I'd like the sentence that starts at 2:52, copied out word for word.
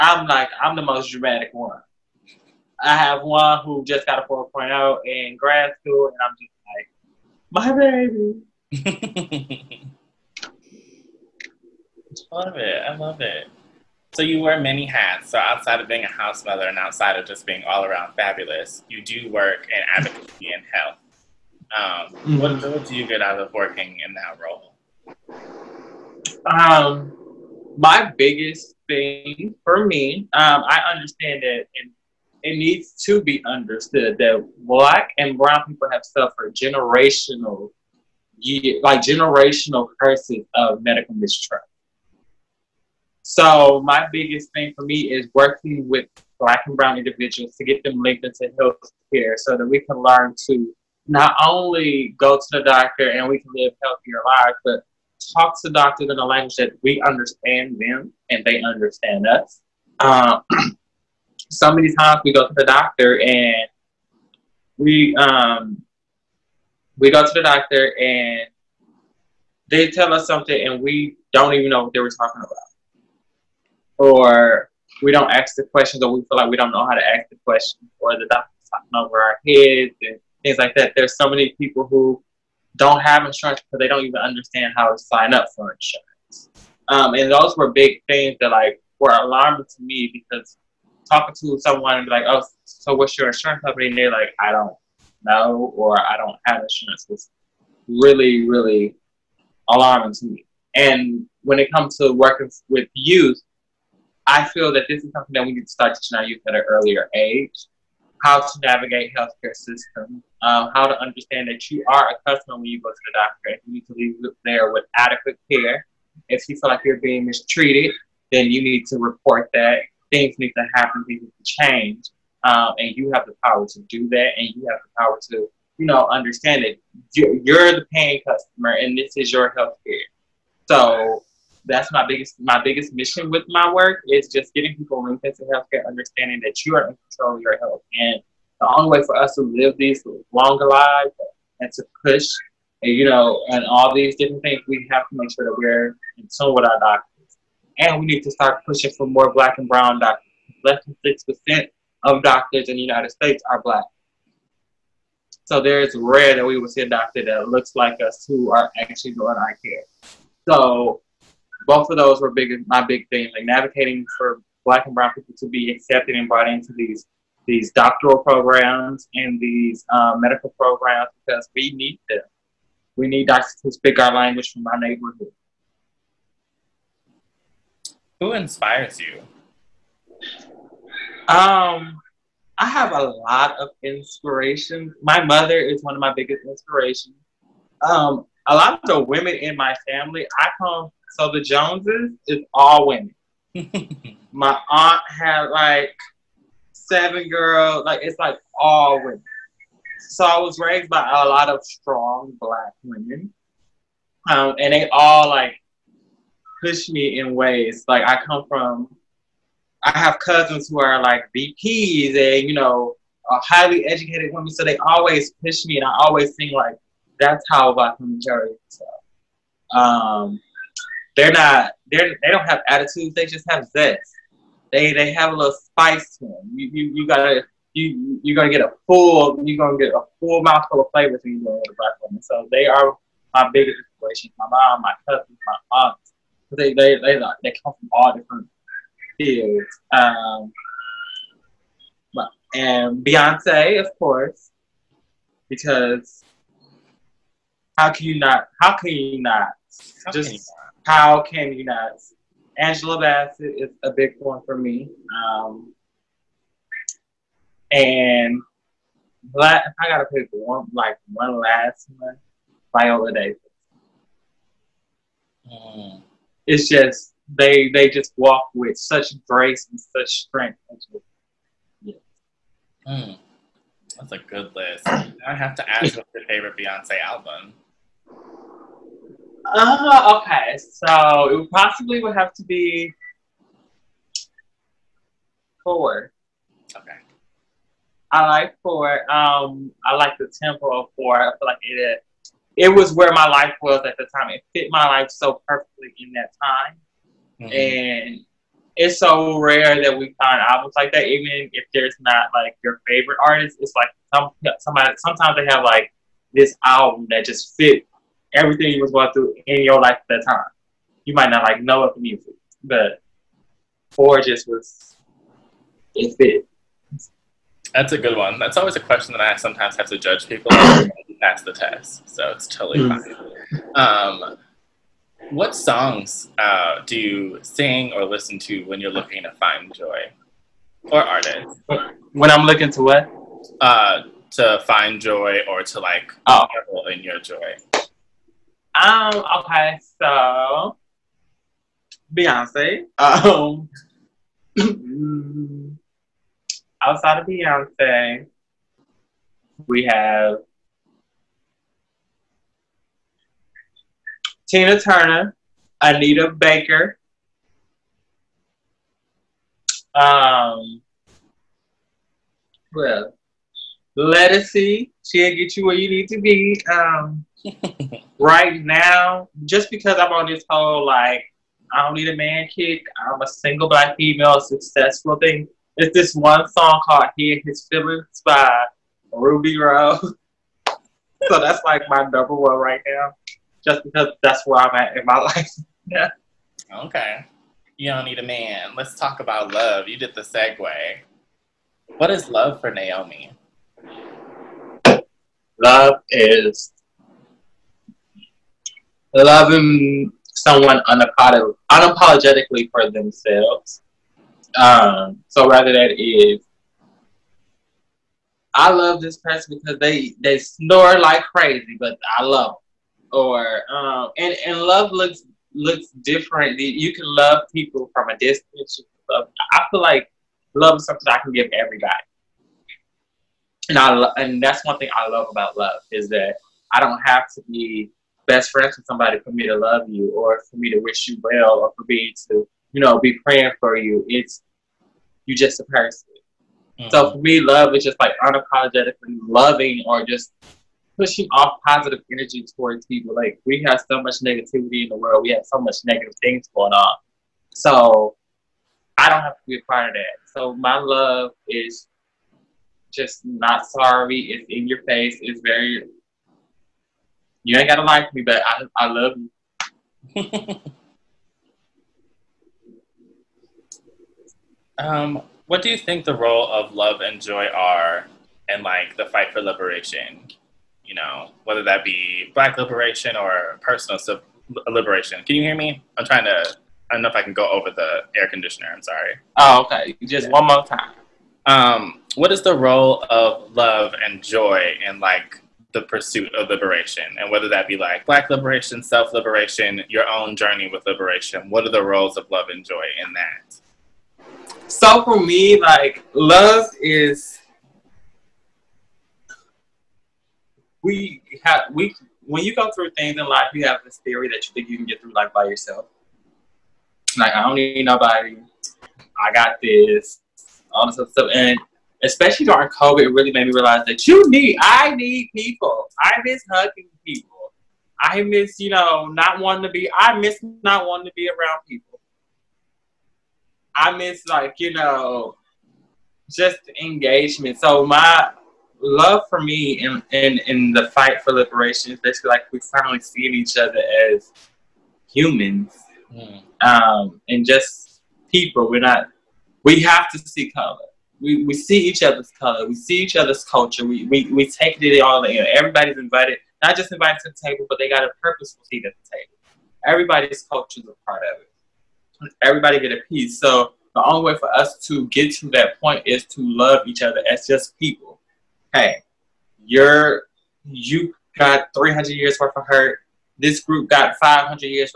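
We need doctors to speak our language from our neighborhood.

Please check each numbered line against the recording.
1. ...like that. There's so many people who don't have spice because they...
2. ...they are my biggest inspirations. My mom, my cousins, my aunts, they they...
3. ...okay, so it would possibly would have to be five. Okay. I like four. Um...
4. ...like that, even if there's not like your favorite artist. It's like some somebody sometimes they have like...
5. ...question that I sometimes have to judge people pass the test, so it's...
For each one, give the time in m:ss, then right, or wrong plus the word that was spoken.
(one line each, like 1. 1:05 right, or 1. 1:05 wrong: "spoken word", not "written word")
1. 1:20 wrong: "insurance", not "spice"
2. 3:52 right
3. 4:40 wrong: "four", not "five"
4. 5:00 right
5. 5:18 right.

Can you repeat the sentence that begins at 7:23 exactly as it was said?
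Like we have so much negativity in the world.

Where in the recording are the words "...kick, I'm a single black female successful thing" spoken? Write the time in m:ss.
6:12.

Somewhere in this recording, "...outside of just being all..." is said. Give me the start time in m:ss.
0:16.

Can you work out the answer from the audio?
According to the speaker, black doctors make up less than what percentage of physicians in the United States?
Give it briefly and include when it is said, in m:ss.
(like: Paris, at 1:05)
6%, at 2:31.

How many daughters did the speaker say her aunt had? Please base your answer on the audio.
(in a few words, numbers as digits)
7.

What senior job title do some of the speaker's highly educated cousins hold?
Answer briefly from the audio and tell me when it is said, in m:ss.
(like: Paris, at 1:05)
VPs, at 3:31.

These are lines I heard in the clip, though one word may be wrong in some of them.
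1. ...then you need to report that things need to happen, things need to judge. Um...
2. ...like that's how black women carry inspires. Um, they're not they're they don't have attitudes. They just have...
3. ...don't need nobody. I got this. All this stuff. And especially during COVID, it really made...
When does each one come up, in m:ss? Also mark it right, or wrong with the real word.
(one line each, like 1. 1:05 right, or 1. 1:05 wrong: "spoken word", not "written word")
1. 1:58 wrong: "change", not "judge"
2. 3:36 wrong: "themselves", not "inspires"
3. 8:27 right.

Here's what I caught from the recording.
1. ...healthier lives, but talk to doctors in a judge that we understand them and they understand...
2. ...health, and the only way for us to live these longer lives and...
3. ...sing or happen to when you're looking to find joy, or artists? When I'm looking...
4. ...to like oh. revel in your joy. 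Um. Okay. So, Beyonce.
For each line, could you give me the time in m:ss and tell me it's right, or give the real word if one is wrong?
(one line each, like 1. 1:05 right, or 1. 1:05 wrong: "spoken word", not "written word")
1. 0:53 wrong: "language", not "judge"
2. 2:17 right
3. 5:27 wrong: "listen", not "happen"
4. 5:35 right.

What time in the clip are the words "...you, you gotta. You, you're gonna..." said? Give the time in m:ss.
3:46.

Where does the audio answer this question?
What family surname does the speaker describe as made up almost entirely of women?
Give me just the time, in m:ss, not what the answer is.
3:11.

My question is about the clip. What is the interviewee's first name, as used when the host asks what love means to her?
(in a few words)
Naomi.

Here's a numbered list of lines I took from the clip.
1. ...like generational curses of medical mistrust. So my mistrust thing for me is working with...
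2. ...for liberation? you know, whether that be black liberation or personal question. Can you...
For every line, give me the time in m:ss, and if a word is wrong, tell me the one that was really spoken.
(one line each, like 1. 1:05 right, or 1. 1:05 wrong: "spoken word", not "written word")
1. 0:38 wrong: "biggest", not "mistrust"
2. 7:49 wrong: "liberation", not "question".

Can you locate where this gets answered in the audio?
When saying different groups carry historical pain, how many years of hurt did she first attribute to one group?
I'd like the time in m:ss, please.
9:21.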